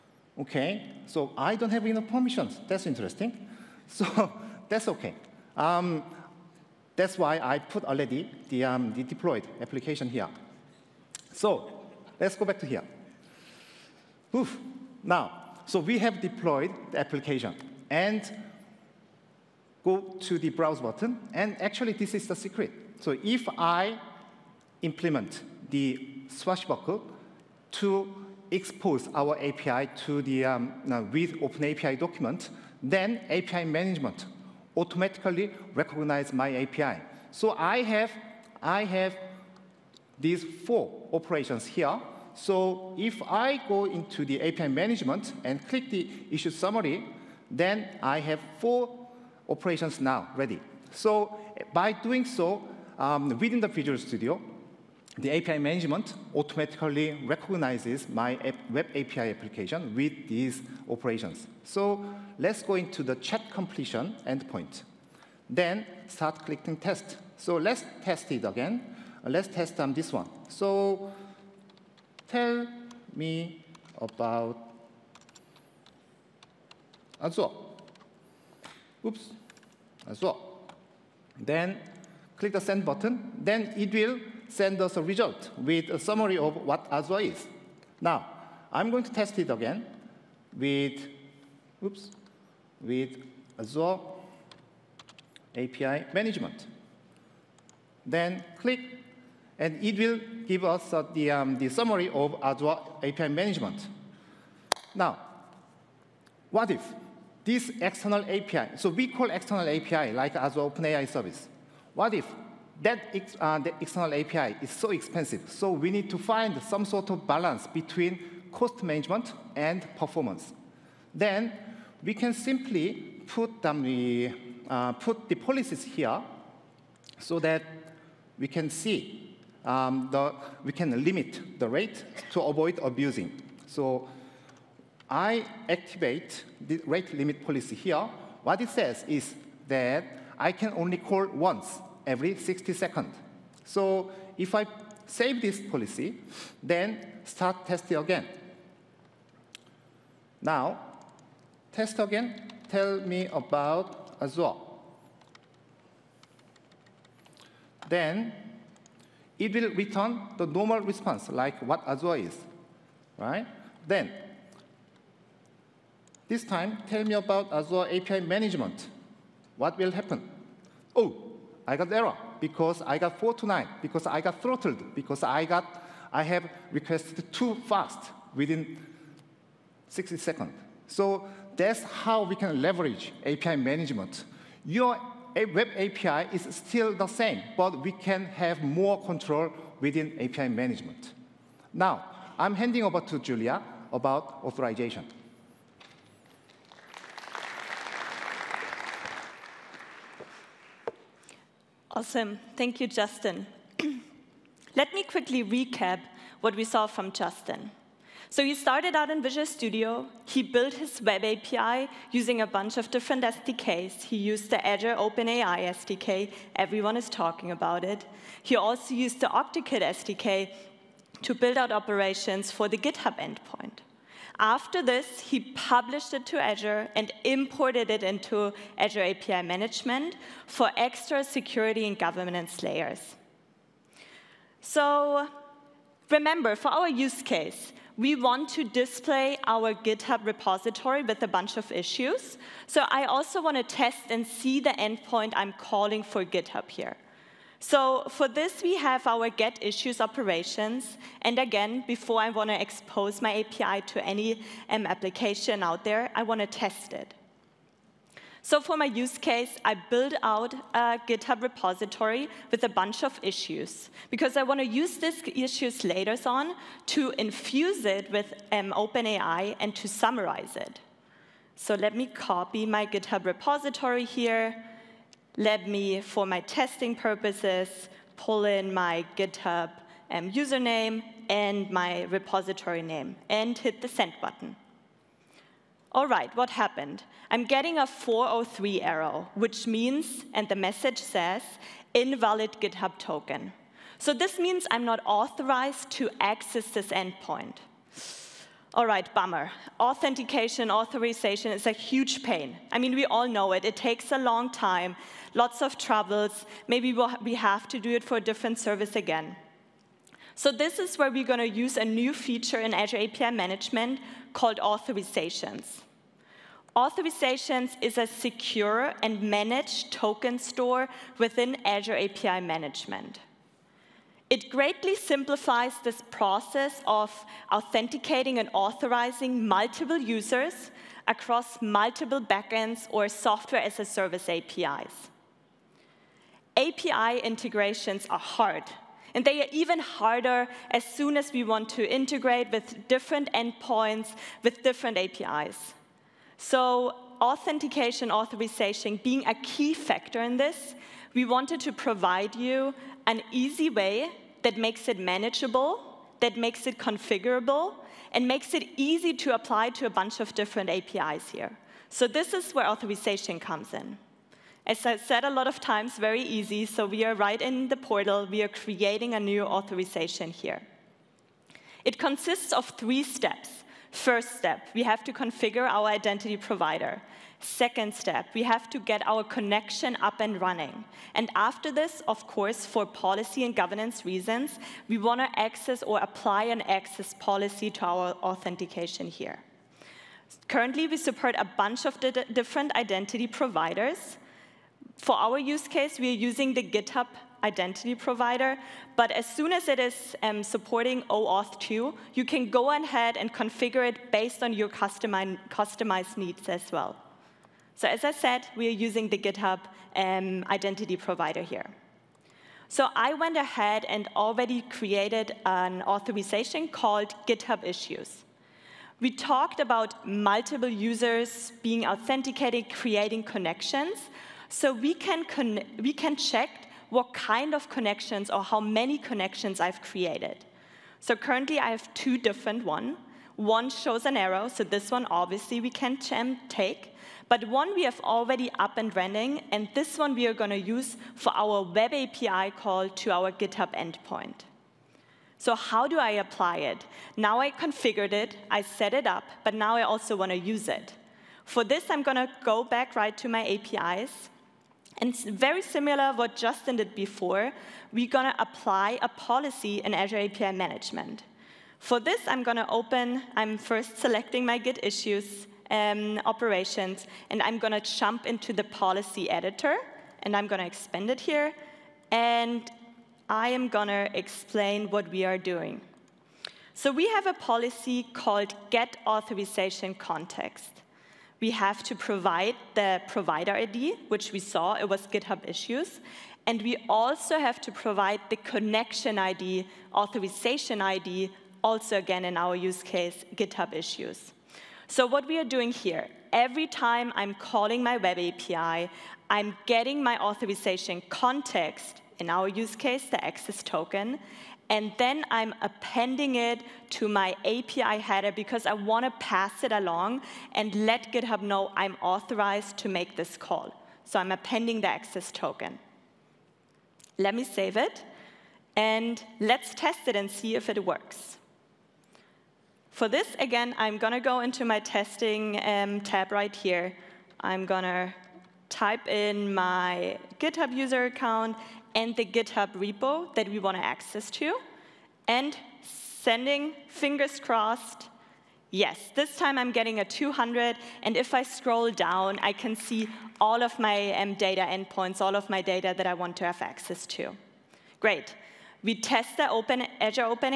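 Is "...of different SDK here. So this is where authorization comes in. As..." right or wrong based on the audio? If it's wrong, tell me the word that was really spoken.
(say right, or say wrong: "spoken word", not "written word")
wrong: "APIs", not "SDK".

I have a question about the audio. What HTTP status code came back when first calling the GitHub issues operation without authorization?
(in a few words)
403.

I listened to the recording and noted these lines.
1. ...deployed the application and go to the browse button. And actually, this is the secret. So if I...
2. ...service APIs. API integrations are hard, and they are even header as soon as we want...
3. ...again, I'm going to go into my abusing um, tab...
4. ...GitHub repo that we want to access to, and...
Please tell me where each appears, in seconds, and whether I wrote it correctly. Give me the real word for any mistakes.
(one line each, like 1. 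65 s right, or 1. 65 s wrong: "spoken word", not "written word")
1. 16 s right
2. 333 s wrong: "harder", not "header"
3. 523 s wrong: "testing", not "abusing"
4. 532 s right.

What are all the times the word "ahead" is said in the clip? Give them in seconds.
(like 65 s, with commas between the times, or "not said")
402 s, 413 s.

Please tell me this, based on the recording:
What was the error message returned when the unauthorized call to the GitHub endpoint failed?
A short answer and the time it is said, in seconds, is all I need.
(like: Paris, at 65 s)
Invalid GitHub token, at 291 s.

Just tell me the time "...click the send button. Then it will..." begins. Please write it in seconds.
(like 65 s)
82 s.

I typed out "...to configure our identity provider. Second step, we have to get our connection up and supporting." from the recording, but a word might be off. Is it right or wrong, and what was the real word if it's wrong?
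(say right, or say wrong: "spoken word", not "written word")
wrong: "running", not "supporting".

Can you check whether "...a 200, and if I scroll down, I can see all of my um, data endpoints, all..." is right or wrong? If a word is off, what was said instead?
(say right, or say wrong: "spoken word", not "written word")
right.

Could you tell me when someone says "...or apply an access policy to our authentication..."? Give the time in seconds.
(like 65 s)
385 s.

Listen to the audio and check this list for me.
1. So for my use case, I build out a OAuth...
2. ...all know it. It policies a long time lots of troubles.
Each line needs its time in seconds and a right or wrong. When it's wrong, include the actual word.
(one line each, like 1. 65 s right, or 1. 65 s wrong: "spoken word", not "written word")
1. 258 s wrong: "GitHub", not "OAuth"
2. 303 s wrong: "takes", not "policies".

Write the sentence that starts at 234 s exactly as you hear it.
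So remember, for our use case, we want to display our GitHub repository with a bunch of issues.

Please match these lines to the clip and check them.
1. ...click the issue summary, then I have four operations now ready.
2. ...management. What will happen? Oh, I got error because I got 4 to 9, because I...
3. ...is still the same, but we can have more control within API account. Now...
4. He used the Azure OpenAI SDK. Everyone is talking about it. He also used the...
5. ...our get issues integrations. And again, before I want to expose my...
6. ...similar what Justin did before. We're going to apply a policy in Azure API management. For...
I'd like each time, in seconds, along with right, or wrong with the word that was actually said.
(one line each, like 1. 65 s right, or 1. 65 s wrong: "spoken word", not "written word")
1. 45 s right
2. 168 s right
3. 186 s wrong: "management", not "account"
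4. 214 s right
5. 249 s wrong: "operations", not "integrations"
6. 455 s right.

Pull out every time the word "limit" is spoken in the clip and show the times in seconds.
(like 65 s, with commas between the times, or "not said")
131 s, 137 s.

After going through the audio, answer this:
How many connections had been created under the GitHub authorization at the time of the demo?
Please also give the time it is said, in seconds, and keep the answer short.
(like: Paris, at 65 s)
2, at 431 s.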